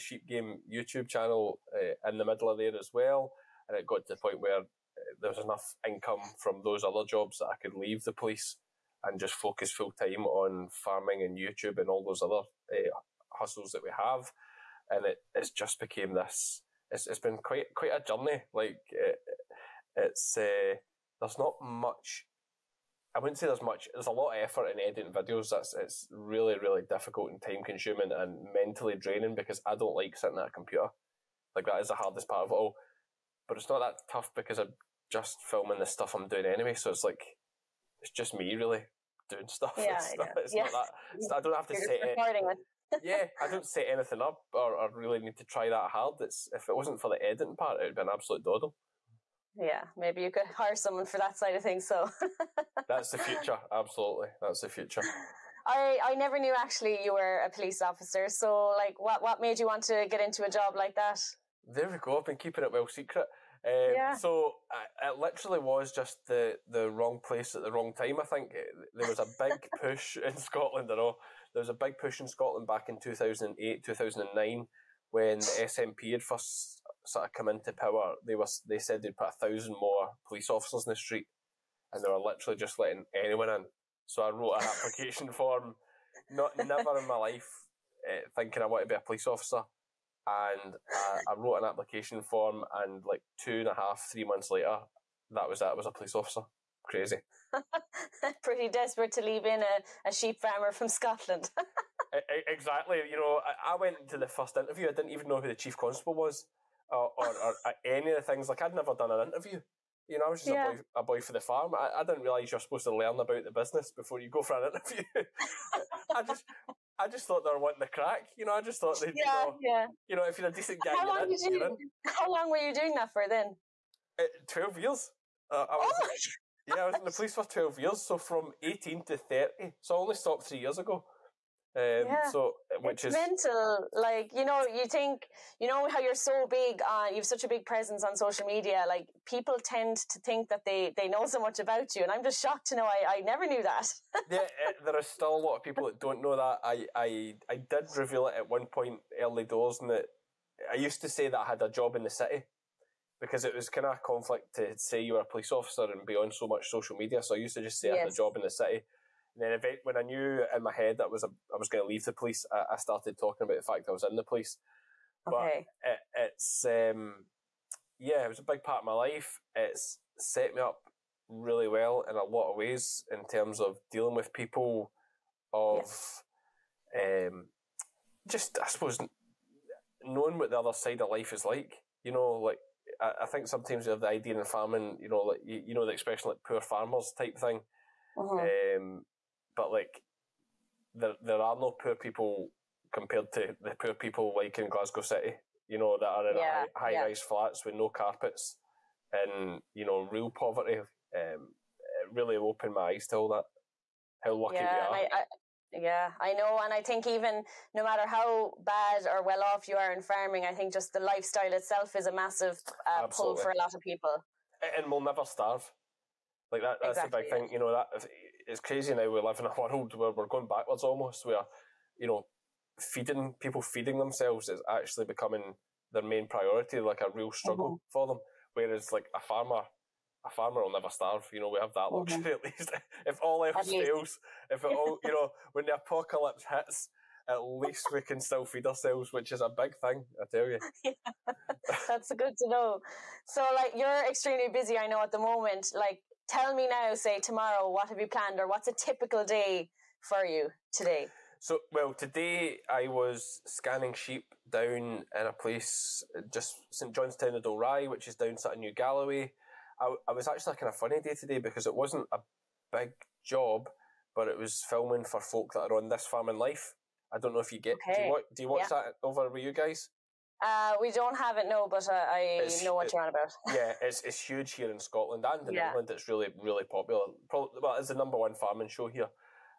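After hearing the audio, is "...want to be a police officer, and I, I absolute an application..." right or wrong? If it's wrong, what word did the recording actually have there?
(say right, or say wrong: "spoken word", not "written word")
wrong: "wrote", not "absolute".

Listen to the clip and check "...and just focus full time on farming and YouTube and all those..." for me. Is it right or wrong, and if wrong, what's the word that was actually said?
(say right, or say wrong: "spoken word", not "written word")
right.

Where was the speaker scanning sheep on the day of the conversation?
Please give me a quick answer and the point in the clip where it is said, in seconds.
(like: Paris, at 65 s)
St John's Town of Dalry, at 256 s.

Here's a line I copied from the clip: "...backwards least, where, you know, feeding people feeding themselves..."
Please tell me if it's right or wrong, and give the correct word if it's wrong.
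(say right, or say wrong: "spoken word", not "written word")
wrong: "almost", not "least".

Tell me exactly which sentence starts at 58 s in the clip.
So like, what what made you want to get into a job like that?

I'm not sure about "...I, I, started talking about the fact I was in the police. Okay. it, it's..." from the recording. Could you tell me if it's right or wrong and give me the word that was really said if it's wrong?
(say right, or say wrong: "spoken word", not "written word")
right.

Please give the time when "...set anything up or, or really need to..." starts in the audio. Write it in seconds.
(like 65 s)
43 s.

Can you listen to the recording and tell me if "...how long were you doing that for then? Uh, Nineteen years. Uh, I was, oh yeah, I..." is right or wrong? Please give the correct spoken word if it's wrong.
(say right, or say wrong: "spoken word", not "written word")
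wrong: "Twelve", not "Nineteen".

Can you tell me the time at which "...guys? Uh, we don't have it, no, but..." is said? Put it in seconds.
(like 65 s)
269 s.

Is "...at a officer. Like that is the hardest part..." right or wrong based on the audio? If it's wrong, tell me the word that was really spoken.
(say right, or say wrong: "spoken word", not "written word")
wrong: "computer", not "officer".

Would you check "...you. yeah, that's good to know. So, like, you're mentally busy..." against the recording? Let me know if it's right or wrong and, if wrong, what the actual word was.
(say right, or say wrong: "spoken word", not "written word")
wrong: "extremely", not "mentally".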